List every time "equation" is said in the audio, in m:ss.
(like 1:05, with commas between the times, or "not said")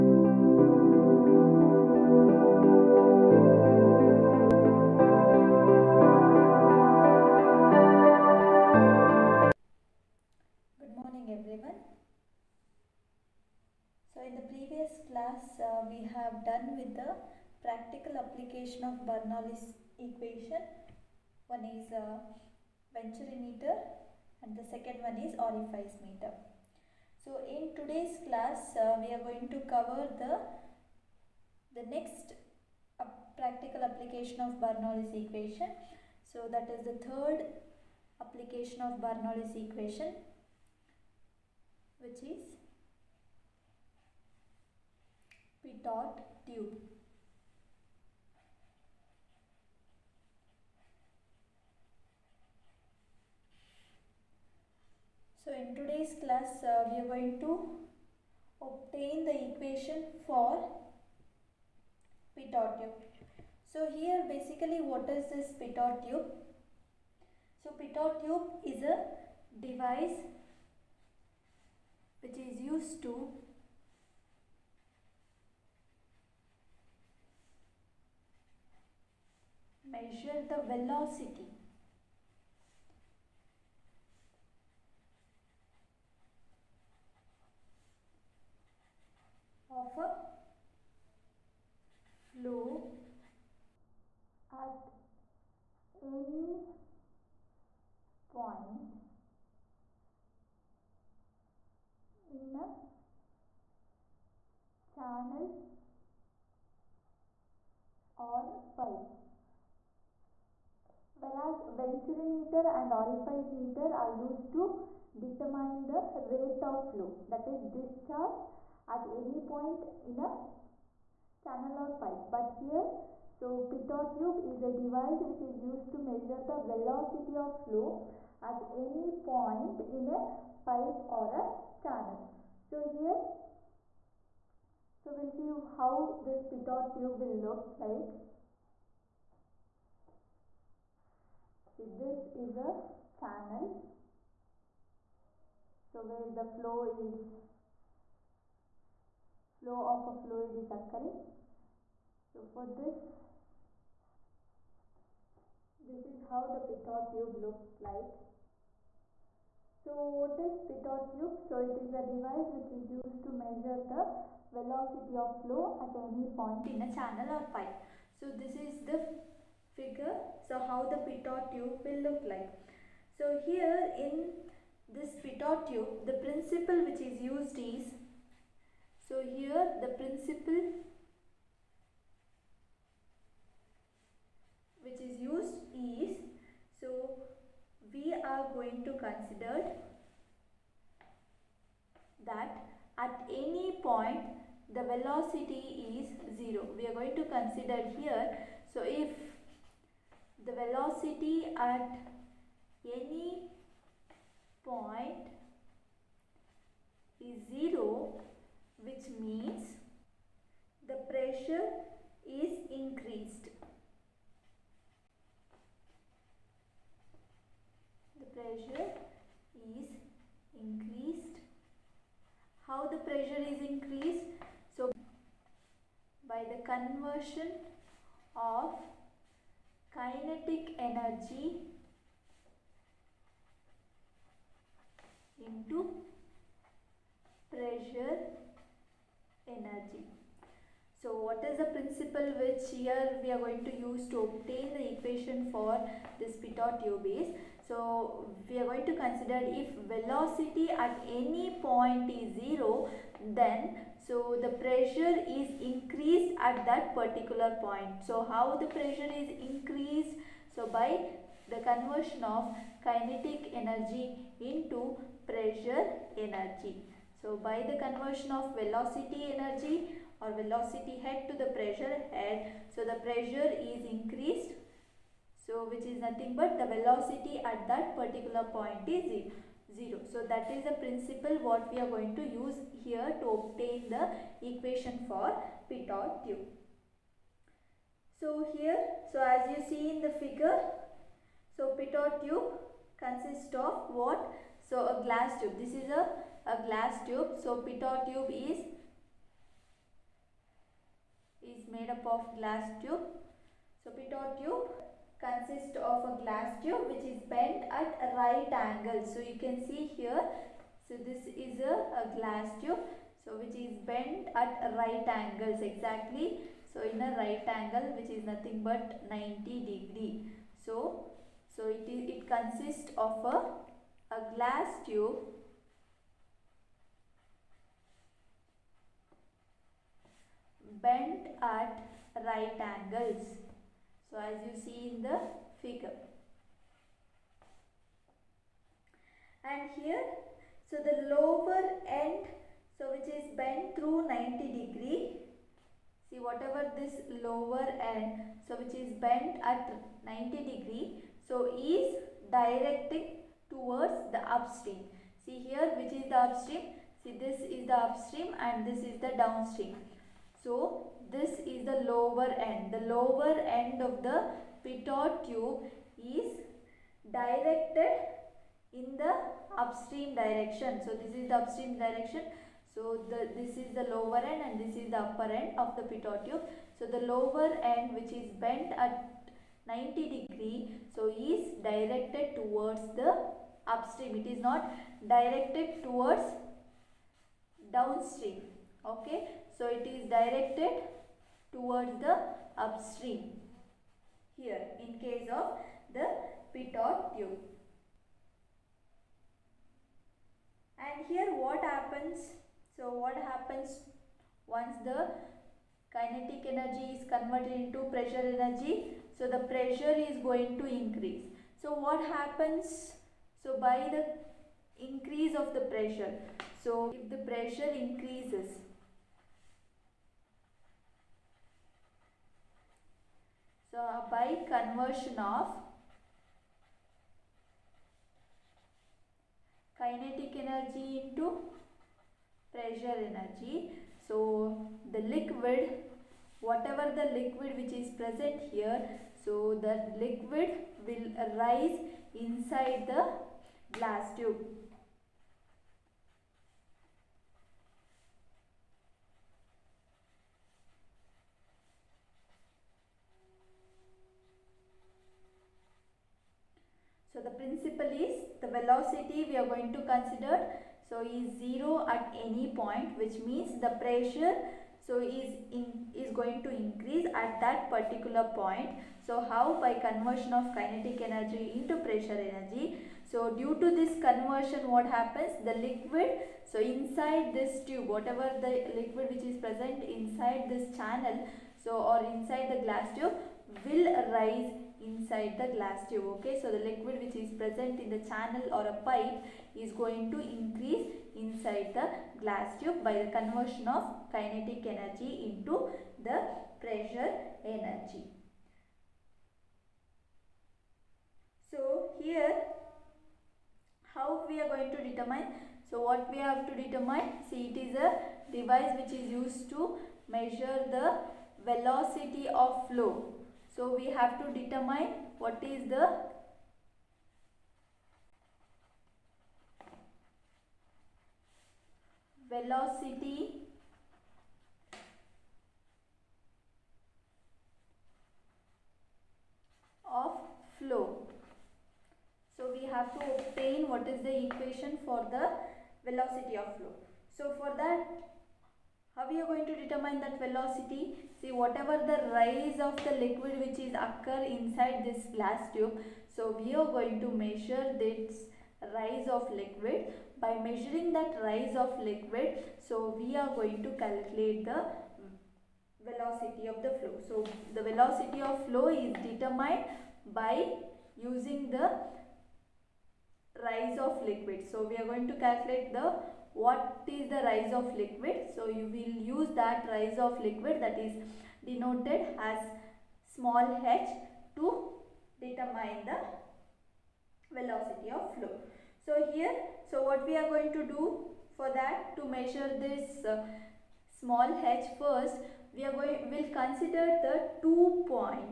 0:20, 0:35, 0:39, 0:59, 4:04, 4:44, 8:54.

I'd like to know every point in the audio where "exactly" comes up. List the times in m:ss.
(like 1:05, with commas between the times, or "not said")
5:15.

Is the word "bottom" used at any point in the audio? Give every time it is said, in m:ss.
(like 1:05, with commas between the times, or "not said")
not said.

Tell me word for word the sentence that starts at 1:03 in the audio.
So here basically what is this p dot tube?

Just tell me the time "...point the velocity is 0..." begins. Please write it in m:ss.
3:13.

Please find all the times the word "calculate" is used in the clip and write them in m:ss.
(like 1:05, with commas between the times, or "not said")
9:13, 9:25.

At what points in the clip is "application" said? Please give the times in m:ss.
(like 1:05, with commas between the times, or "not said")
0:18, 0:33, 0:38.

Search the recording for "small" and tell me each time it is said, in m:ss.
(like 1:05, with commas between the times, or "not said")
9:33, 9:44.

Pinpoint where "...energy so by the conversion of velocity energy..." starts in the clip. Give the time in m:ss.
4:26.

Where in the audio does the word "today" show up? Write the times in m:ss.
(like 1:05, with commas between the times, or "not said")
0:27, 0:55.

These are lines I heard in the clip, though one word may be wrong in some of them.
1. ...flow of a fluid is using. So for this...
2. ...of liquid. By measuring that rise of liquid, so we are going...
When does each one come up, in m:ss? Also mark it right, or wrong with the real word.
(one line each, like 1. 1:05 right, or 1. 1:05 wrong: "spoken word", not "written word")
1. 2:29 wrong: "occurring", not "using"
2. 9:09 right.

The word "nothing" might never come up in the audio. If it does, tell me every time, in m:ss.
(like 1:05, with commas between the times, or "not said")
4:36, 5:18.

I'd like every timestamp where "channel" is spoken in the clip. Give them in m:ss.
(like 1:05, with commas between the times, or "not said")
2:01, 2:11, 2:23, 2:46, 8:00, 8:08.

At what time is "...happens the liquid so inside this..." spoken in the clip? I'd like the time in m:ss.
7:54.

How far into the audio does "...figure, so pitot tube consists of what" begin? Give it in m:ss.
4:50.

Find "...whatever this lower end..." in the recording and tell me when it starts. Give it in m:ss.
5:46.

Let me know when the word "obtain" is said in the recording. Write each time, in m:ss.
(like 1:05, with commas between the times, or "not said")
0:58, 4:04, 4:43, 8:53.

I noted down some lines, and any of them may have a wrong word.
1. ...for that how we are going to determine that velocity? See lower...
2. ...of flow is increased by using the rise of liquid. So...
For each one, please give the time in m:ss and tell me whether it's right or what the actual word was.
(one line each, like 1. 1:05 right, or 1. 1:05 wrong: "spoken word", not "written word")
1. 8:57 wrong: "whatever", not "lower"
2. 9:18 wrong: "determined", not "increased".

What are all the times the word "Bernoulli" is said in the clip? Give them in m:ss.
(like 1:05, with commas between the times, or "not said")
0:19, 0:34, 0:39.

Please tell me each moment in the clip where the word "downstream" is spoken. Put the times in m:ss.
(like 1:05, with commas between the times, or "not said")
5:59, 6:27.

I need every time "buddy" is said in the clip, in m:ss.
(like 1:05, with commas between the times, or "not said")
not said.